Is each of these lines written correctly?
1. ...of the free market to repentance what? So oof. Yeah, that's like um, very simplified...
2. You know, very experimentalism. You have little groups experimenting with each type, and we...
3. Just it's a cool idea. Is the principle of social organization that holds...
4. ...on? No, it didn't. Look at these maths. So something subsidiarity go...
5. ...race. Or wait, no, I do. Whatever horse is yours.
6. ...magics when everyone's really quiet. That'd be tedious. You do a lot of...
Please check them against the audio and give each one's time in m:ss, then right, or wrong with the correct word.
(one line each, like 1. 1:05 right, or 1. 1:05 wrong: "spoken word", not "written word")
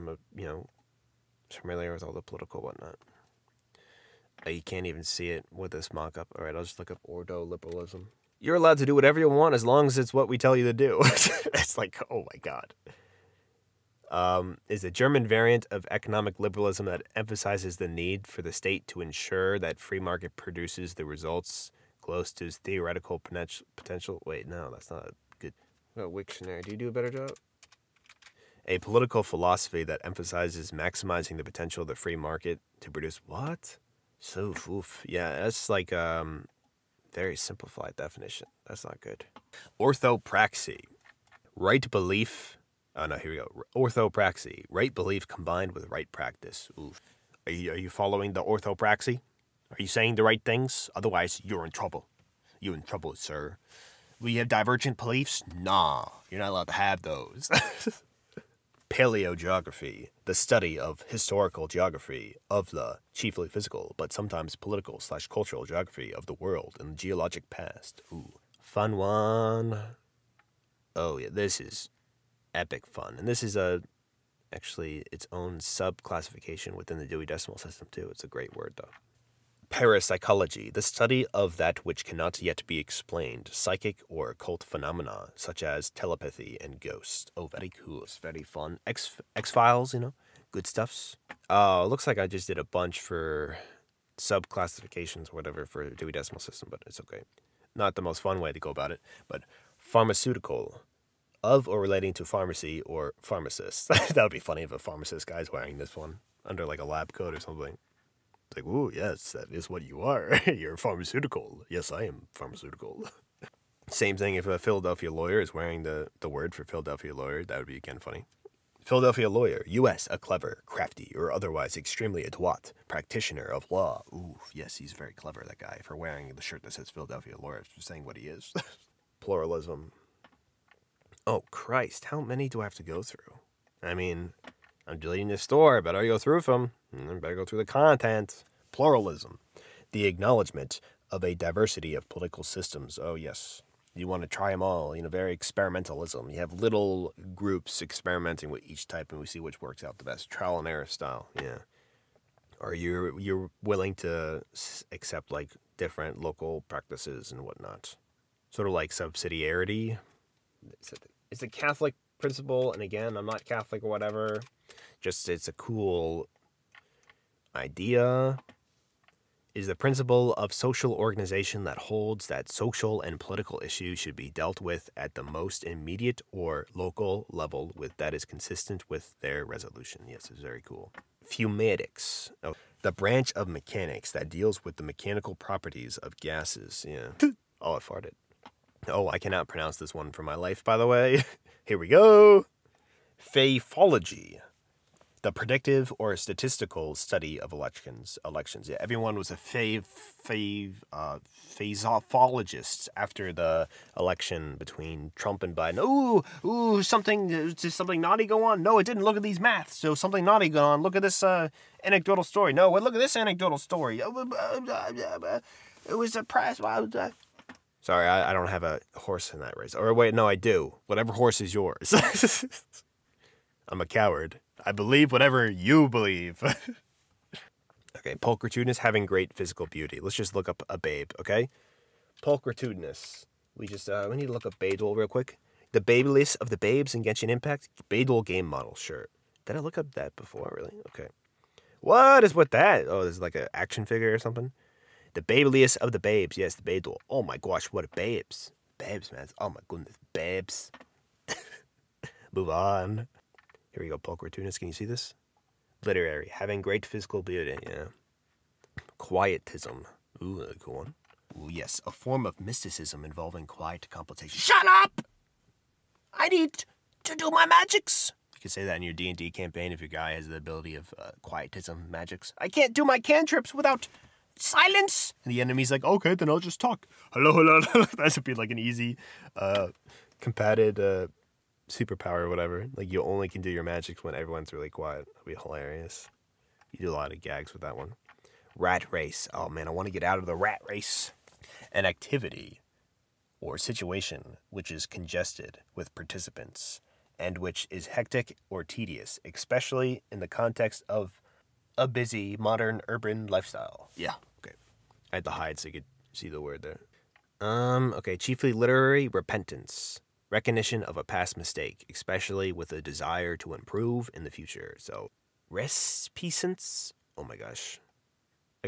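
1. 0:31 wrong: "produce", not "repentance"
2. 2:24 right
3. 2:45 right
4. 3:28 wrong: "naughty", not "subsidiarity"
5. 3:39 right
6. 4:43 wrong: "hilarious", not "tedious".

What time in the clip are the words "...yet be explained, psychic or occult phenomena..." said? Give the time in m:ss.
1:22.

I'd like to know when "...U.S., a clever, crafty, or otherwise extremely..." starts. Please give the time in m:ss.
1:59.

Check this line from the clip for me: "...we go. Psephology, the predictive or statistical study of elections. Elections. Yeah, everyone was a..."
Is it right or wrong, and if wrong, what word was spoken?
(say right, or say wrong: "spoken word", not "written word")
right.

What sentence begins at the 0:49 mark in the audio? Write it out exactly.
Are you saying the right things?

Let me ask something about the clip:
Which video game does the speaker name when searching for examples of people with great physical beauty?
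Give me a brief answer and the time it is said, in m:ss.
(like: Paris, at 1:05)
Genshin Impact, at 3:57.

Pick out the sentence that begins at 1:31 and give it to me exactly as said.
Uh, looks like I just did a bunch for classifications or whatever for Dewey Decimal System, but it's okay.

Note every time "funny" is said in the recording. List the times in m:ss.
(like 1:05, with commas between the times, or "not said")
1:44, 1:57.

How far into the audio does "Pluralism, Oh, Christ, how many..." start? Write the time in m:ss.
2:09.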